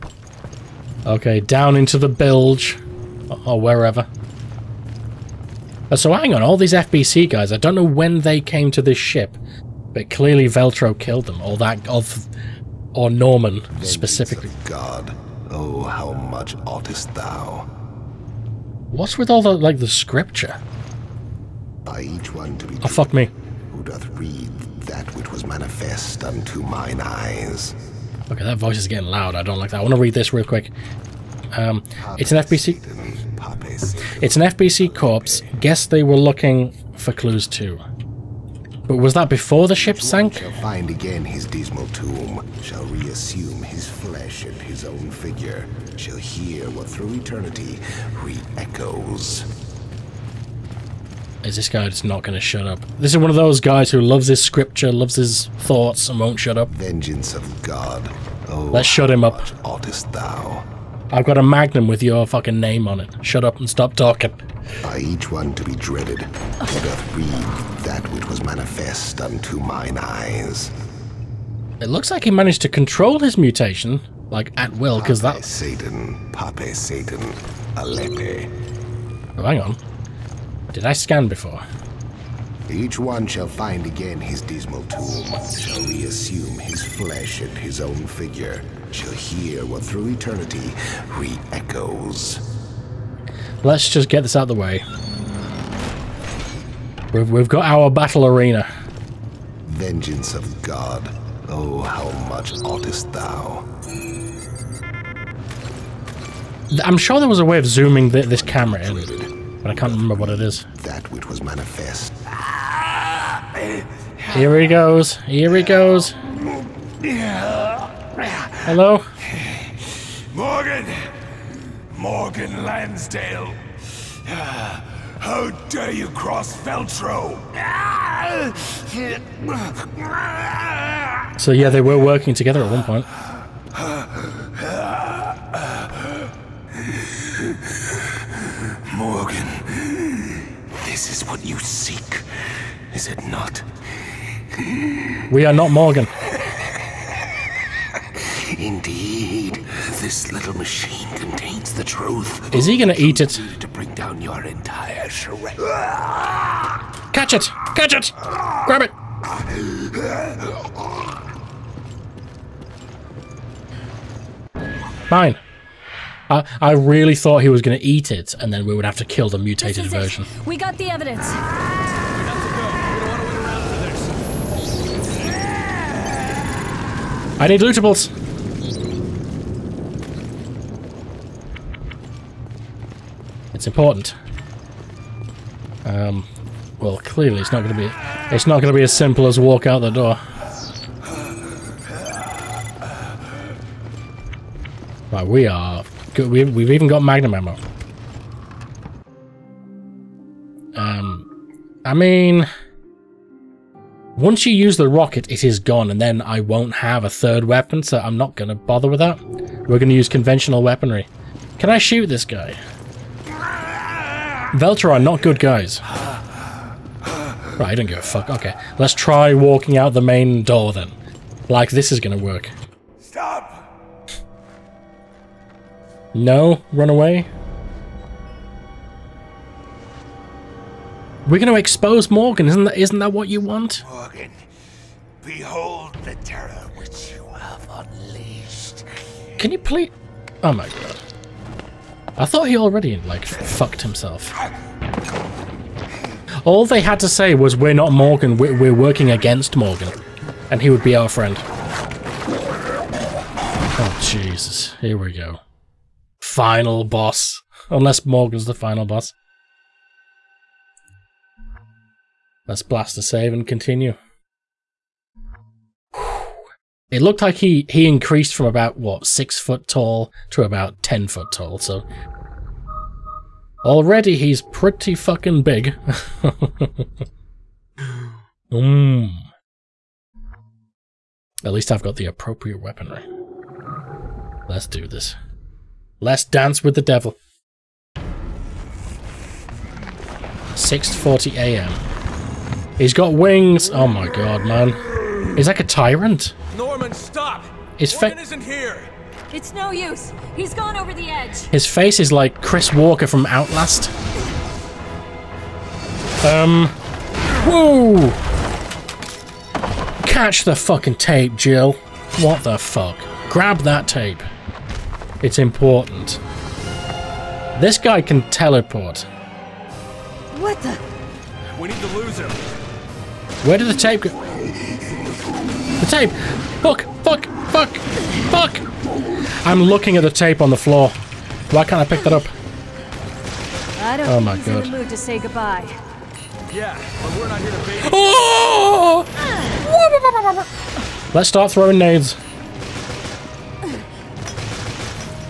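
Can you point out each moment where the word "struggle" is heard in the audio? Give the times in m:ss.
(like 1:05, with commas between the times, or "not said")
not said.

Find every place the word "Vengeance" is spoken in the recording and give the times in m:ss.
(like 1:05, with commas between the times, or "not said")
0:13, 0:56, 1:39.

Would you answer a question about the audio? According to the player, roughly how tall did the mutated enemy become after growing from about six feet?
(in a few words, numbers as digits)
10 feet.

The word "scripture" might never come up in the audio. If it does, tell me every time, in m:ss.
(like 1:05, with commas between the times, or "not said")
0:19, 0:54.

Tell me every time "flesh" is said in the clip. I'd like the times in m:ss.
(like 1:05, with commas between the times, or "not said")
0:43, 1:26.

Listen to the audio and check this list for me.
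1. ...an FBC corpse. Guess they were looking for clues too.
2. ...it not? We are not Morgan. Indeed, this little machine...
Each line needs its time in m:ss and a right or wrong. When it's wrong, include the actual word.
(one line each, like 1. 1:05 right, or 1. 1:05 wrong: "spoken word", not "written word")
1. 0:34 right
2. 2:23 right.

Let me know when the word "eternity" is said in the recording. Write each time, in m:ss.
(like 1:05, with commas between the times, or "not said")
0:47, 1:30.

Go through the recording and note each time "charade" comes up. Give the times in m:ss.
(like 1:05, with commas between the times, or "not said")
2:35.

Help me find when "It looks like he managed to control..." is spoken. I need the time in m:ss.
1:11.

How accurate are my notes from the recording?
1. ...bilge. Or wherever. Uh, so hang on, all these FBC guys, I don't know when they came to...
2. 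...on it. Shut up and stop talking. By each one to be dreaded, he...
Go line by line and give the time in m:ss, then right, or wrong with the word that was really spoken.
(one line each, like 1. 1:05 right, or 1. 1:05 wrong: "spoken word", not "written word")
1. 0:02 right
2. 1:02 right.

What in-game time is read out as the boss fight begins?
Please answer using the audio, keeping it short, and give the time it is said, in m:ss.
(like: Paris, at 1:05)
6:40 a.m., at 4:47.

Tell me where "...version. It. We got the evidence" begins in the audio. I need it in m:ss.
2:49.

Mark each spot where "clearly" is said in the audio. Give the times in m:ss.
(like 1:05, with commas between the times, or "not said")
0:10, 3:06.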